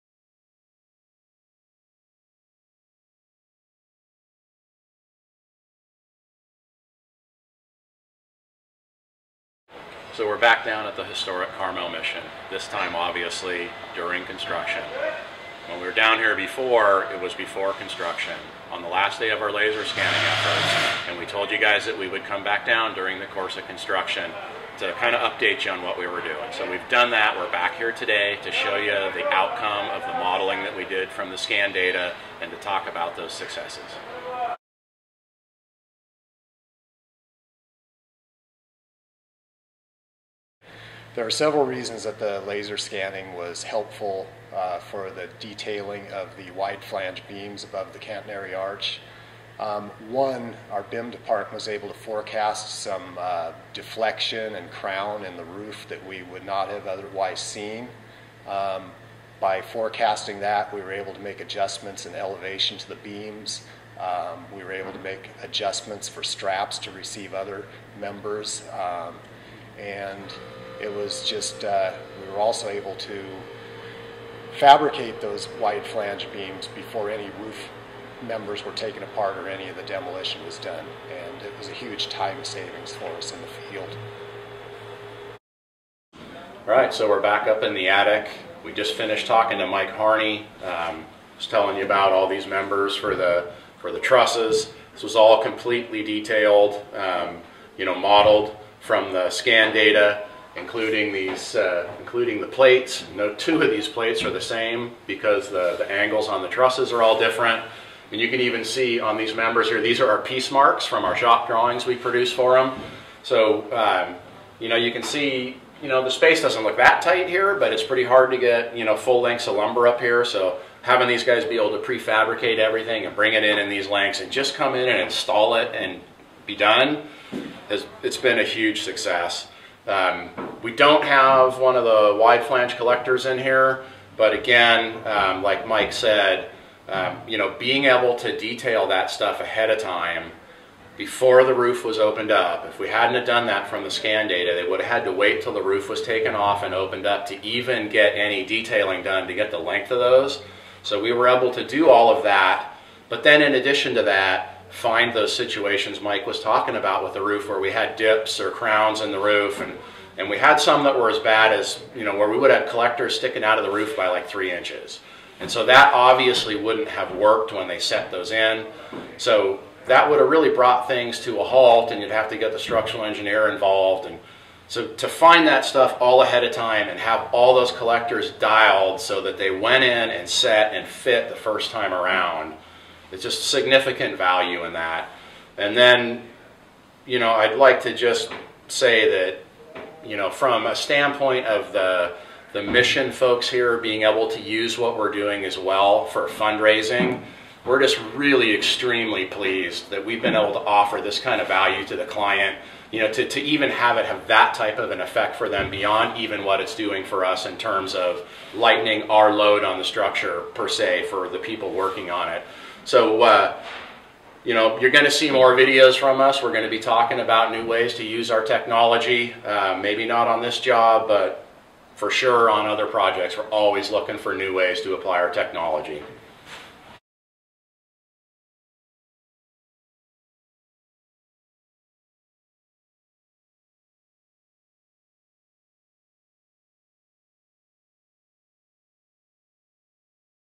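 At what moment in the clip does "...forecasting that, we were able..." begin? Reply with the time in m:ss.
0:59.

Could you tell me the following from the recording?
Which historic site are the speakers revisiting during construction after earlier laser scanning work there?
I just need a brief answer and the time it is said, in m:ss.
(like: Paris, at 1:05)
Carmel mission, at 0:11.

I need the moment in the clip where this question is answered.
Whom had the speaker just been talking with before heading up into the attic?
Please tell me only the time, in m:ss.
1:29.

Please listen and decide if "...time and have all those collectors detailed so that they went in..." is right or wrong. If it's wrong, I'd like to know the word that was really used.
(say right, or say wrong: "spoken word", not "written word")
wrong: "dialed", not "detailed".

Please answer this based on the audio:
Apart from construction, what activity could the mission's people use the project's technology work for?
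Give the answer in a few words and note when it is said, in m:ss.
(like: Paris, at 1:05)
fundraising, at 3:16.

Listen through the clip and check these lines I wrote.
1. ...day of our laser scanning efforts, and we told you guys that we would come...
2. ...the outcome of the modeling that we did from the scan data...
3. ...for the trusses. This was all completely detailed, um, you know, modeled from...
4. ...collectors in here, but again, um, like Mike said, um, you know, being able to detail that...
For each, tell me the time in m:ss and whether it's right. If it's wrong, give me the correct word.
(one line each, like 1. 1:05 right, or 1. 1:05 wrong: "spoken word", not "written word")
1. 0:19 right
2. 0:28 right
3. 1:33 right
4. 2:12 right.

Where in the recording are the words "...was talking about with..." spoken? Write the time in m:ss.
2:36.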